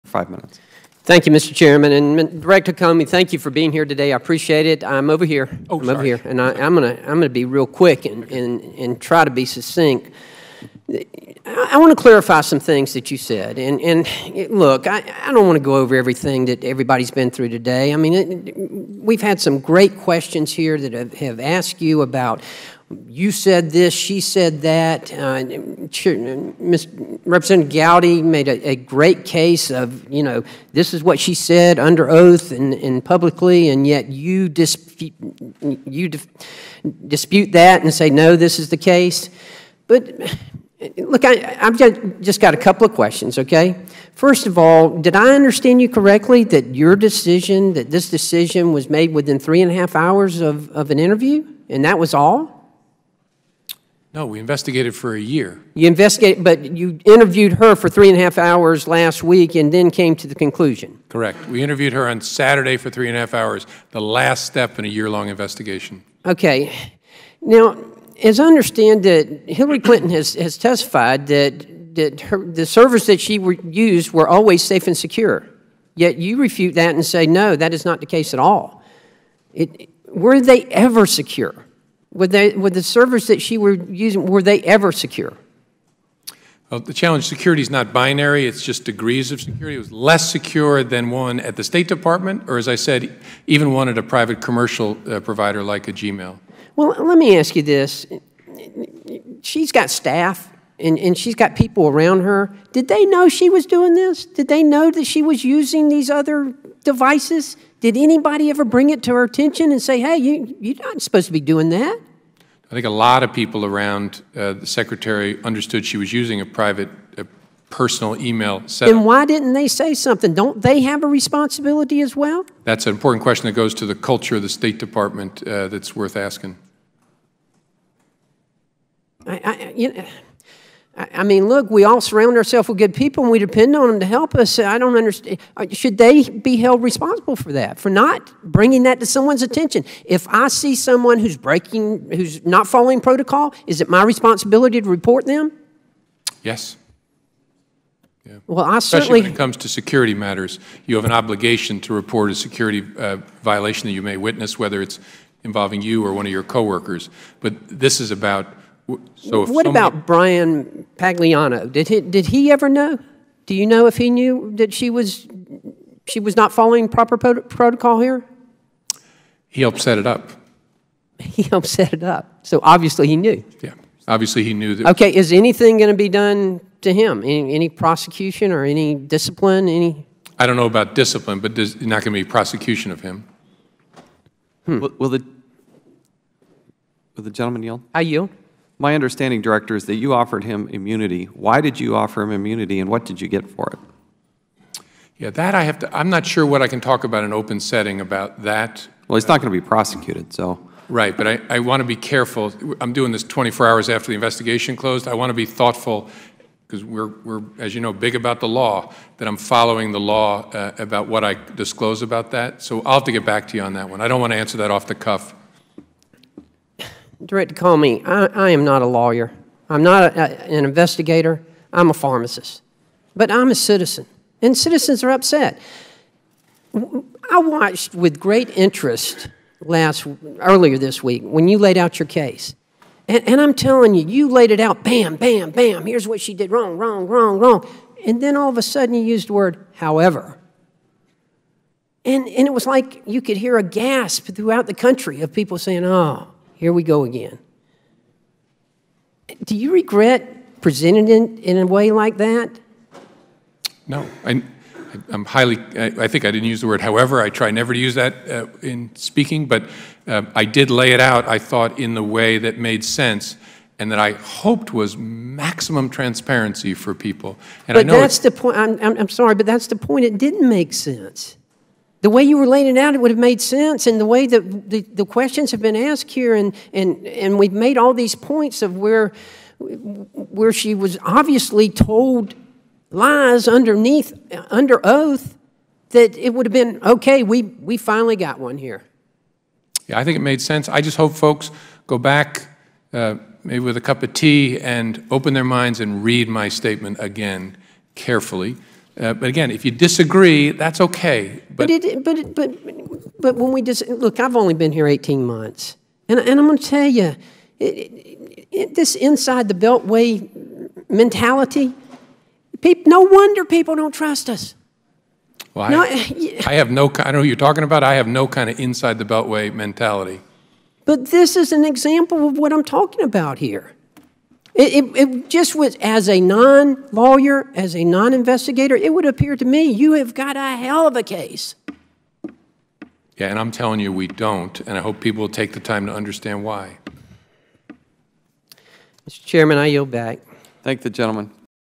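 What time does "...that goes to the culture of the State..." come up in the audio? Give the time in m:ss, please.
2:03.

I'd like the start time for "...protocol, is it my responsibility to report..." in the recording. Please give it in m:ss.
2:22.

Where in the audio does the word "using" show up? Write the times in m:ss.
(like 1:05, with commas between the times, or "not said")
1:23, 1:45, 1:56.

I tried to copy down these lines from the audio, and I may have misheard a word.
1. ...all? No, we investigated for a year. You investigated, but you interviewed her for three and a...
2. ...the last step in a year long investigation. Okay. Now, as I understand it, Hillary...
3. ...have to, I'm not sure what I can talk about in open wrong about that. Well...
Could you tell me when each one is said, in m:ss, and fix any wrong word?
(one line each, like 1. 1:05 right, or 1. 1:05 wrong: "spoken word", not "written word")
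1. 0:52 right
2. 1:03 right
3. 3:15 wrong: "setting", not "wrong".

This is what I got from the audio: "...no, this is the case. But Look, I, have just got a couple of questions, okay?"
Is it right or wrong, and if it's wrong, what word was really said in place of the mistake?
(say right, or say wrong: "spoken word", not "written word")
right.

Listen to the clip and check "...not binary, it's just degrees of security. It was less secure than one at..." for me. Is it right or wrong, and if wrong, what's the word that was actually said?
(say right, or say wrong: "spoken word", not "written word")
right.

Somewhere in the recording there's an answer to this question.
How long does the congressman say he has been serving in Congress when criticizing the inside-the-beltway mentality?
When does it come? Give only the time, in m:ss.
5:04.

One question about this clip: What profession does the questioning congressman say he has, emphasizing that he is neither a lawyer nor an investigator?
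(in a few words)
Pharmacist.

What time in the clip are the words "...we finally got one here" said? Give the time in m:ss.
4:47.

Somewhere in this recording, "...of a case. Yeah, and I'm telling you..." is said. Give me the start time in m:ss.
5:30.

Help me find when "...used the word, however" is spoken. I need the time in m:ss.
3:59.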